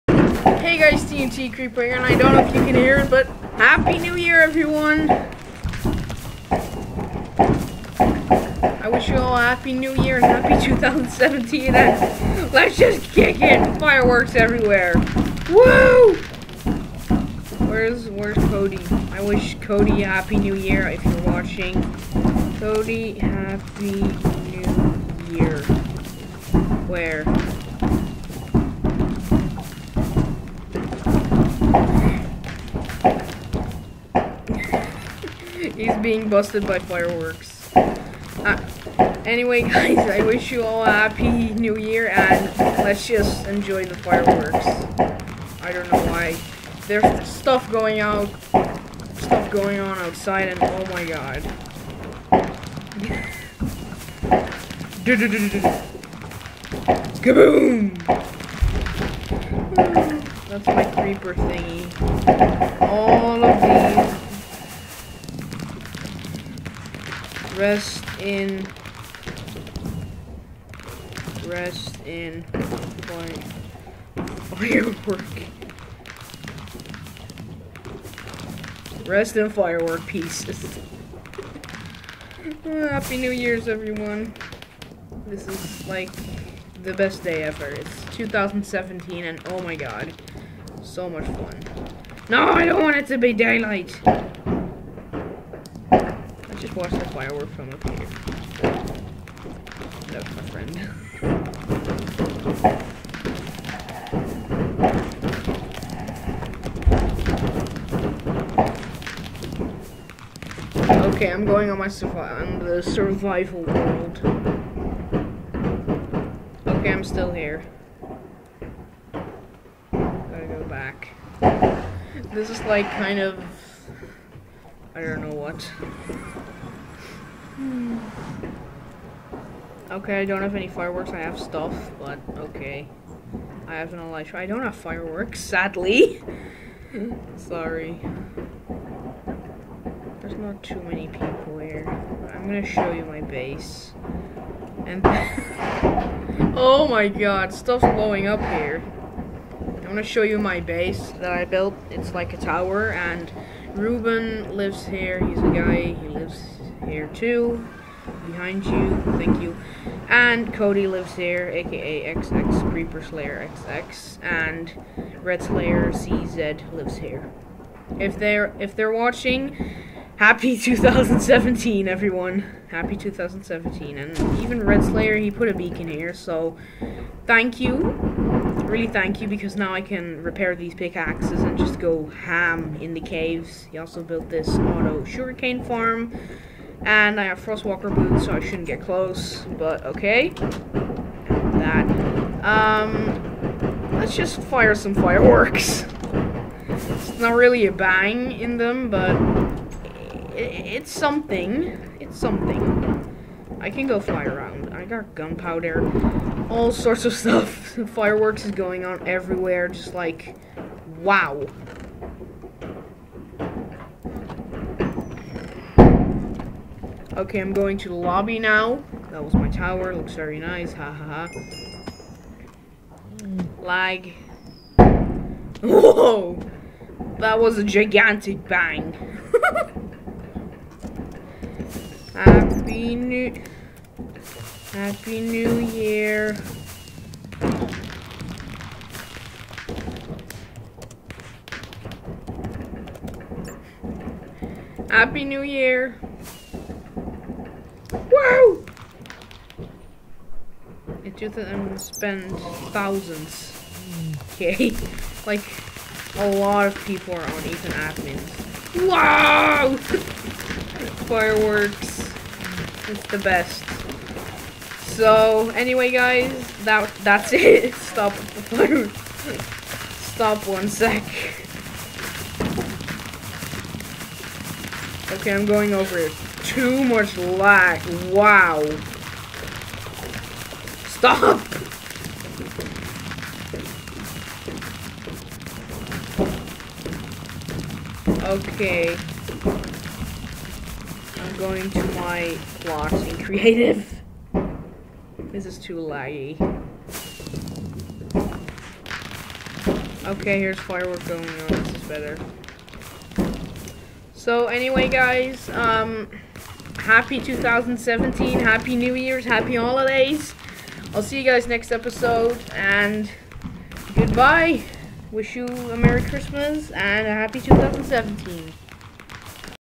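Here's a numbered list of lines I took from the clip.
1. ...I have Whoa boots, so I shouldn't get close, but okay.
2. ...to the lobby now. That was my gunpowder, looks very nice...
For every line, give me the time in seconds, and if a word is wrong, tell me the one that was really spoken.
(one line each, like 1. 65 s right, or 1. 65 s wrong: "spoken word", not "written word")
1. 187 s wrong: "Frostwalker", not "Whoa"
2. 217 s wrong: "tower", not "gunpowder".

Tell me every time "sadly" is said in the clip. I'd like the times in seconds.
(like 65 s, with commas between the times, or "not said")
135 s.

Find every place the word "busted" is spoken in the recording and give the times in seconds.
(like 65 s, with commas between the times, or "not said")
36 s.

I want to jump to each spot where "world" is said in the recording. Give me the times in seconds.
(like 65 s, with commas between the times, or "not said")
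113 s.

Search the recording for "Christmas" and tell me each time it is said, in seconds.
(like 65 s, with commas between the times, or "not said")
316 s.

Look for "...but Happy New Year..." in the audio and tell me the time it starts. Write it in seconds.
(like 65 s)
3 s.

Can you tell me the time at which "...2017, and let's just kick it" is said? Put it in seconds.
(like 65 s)
10 s.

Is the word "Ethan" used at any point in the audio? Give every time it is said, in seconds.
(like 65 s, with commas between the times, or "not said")
257 s.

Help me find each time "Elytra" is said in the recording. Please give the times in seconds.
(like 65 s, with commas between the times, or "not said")
133 s.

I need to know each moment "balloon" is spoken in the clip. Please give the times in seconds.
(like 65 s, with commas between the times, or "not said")
268 s.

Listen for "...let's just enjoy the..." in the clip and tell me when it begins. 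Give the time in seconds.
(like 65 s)
42 s.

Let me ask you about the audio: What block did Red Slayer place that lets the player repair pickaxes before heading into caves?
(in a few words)
beacon.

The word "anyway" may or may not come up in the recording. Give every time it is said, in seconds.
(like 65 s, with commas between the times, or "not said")
39 s, 265 s, 304 s.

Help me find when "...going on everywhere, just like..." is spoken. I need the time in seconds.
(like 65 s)
208 s.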